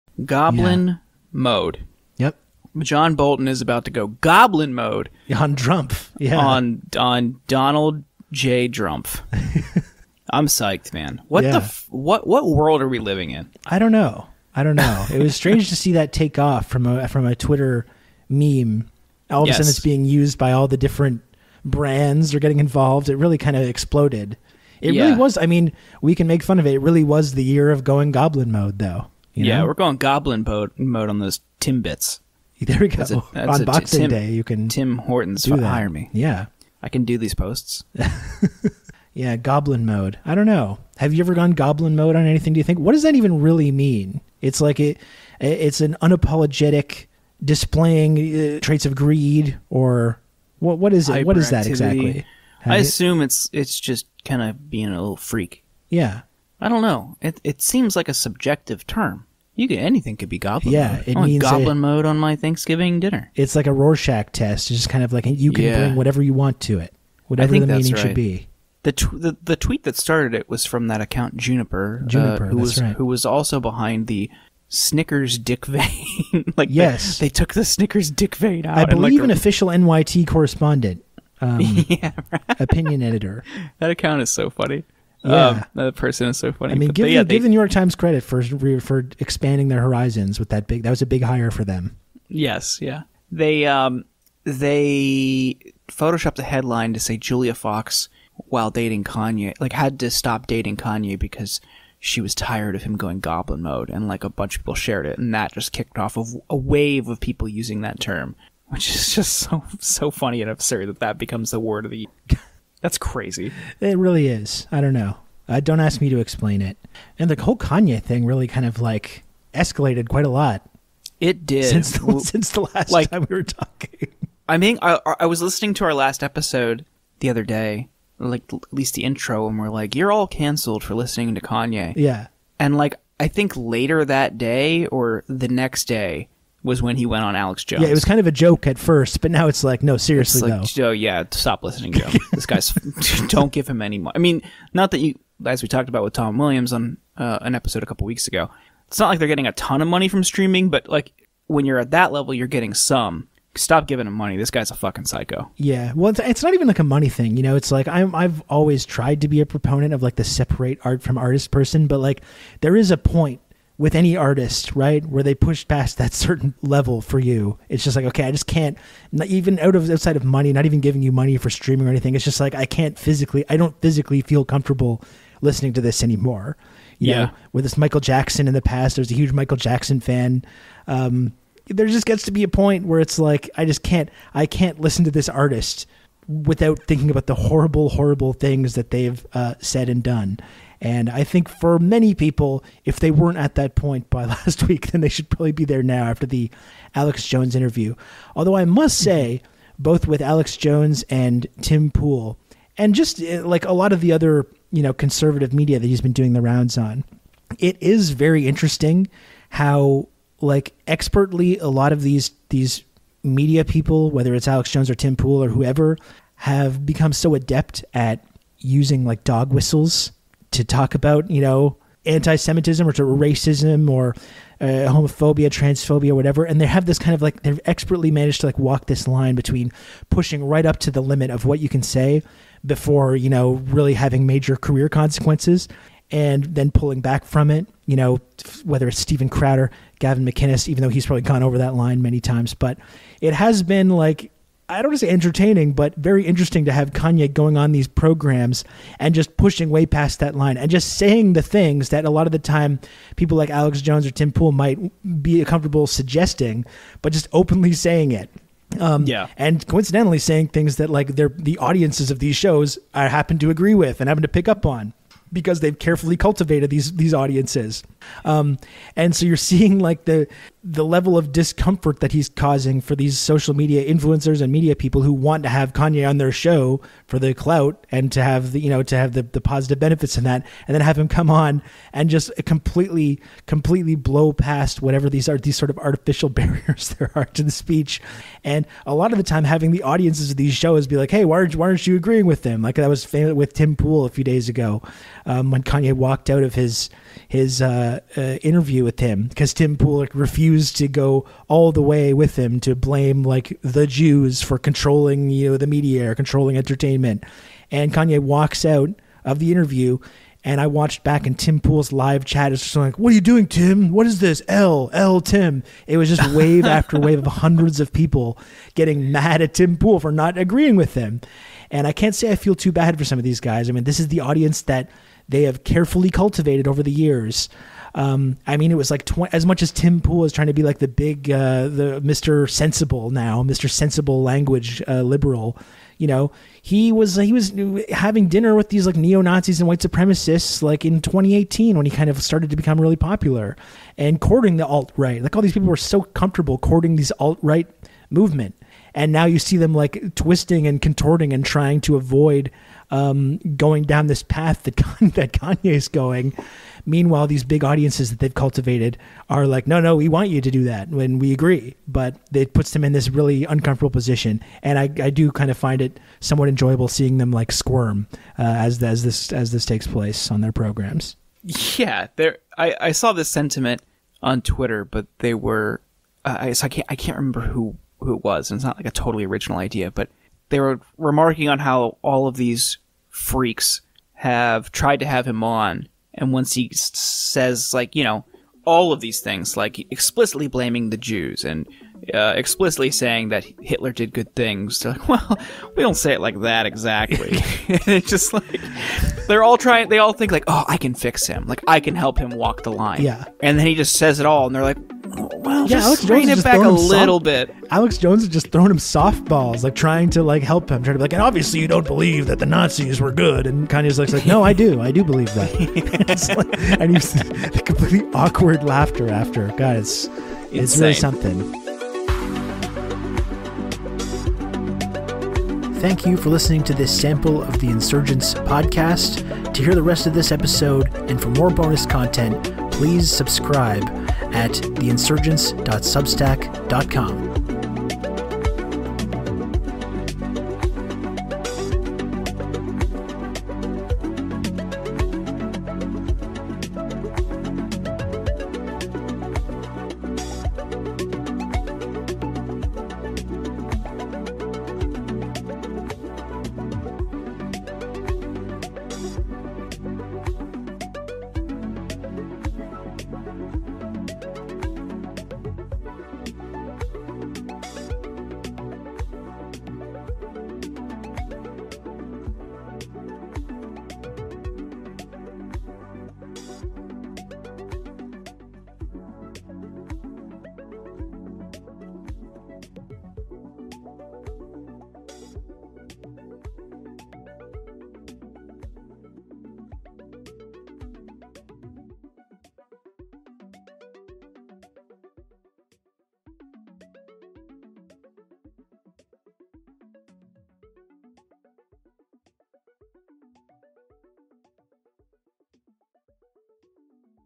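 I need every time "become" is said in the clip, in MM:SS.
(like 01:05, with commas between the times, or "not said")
01:51, 03:36, 05:42.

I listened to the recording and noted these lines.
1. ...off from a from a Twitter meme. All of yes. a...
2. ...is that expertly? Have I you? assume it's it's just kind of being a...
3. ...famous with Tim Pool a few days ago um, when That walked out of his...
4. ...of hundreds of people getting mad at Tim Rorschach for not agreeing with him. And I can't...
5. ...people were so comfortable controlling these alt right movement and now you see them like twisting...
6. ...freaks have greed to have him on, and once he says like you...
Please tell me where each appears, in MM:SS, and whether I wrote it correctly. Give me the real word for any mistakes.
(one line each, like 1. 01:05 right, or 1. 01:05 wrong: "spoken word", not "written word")
1. 00:16 right
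2. 00:51 wrong: "exactly", not "expertly"
3. 04:53 wrong: "Kanye", not "That"
4. 05:17 wrong: "Pool", not "Rorschach"
5. 05:45 wrong: "courting", not "controlling"
6. 06:23 wrong: "tried", not "greed".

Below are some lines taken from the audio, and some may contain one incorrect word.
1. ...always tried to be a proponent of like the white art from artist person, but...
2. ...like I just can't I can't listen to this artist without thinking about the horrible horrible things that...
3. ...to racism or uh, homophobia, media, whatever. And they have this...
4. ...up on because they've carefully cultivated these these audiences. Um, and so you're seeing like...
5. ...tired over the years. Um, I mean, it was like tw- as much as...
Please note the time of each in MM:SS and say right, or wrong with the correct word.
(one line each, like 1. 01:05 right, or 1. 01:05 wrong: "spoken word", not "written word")
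1. 02:38 wrong: "separate", not "white"
2. 03:03 right
3. 03:42 wrong: "transphobia", not "media"
4. 04:24 right
5. 05:26 wrong: "cultivated", not "tired".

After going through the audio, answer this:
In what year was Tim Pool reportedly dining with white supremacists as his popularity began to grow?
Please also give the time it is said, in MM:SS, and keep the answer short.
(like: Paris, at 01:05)
2018, at 05:41.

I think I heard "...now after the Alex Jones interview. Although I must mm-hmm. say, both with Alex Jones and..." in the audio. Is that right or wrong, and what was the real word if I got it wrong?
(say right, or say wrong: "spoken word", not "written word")
right.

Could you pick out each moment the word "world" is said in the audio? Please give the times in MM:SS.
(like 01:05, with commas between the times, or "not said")
00:12.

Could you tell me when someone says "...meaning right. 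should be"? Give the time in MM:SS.
01:07.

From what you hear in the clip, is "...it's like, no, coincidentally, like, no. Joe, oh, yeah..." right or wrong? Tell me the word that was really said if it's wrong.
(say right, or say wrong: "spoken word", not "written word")
wrong: "seriously", not "coincidentally".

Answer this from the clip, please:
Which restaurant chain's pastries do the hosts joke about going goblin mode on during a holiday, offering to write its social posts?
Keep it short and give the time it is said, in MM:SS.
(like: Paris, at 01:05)
Tim Hortons, at 00:34.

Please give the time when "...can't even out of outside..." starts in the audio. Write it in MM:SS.
02:48.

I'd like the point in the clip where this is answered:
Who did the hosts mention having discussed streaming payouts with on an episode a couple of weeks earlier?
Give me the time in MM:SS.
02:26.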